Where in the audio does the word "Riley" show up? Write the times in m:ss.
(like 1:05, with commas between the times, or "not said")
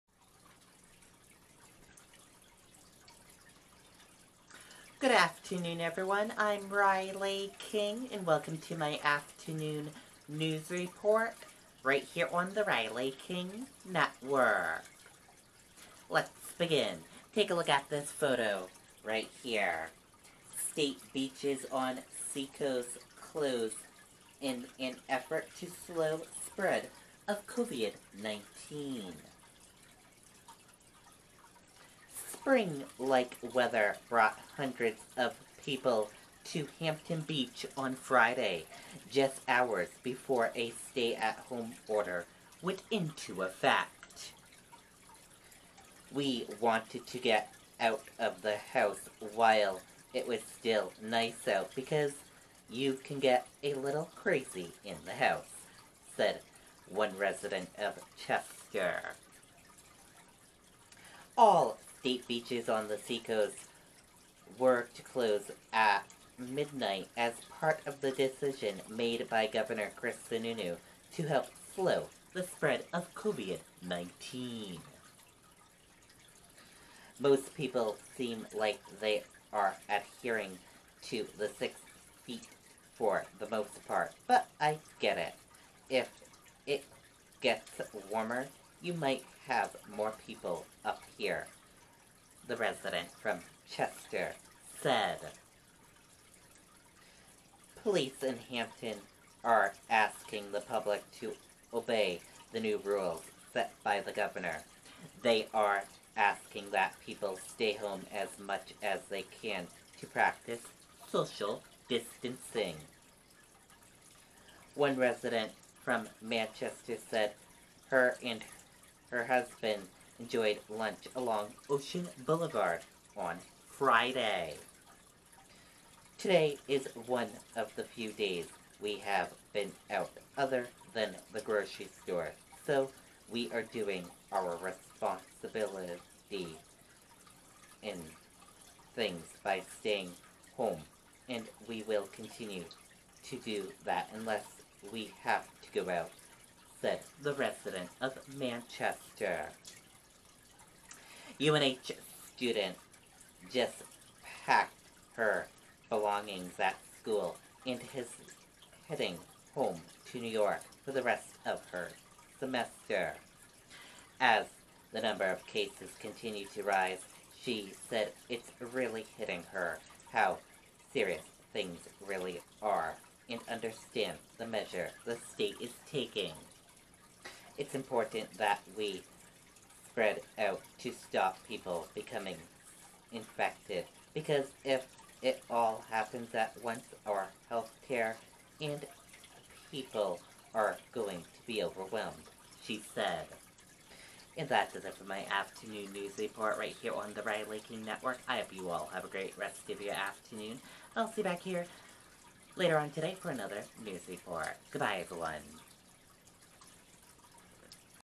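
0:06, 0:12, 3:17.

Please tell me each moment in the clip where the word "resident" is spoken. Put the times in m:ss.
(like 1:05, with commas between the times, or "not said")
0:57, 1:32, 1:54, 2:27.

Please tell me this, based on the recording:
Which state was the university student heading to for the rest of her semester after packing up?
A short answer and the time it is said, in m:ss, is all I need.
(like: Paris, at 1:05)
New York, at 2:40.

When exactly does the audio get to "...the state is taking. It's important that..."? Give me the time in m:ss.
2:55.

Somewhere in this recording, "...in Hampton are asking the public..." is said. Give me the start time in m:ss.
1:38.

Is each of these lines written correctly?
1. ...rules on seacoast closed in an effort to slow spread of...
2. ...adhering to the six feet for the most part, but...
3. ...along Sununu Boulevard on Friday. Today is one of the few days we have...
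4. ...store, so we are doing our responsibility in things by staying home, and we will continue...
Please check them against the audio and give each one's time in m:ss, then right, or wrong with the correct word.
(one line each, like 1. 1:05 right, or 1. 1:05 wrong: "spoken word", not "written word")
1. 0:21 wrong: "beaches", not "rules"
2. 1:19 right
3. 2:01 wrong: "Ocean", not "Sununu"
4. 2:12 right.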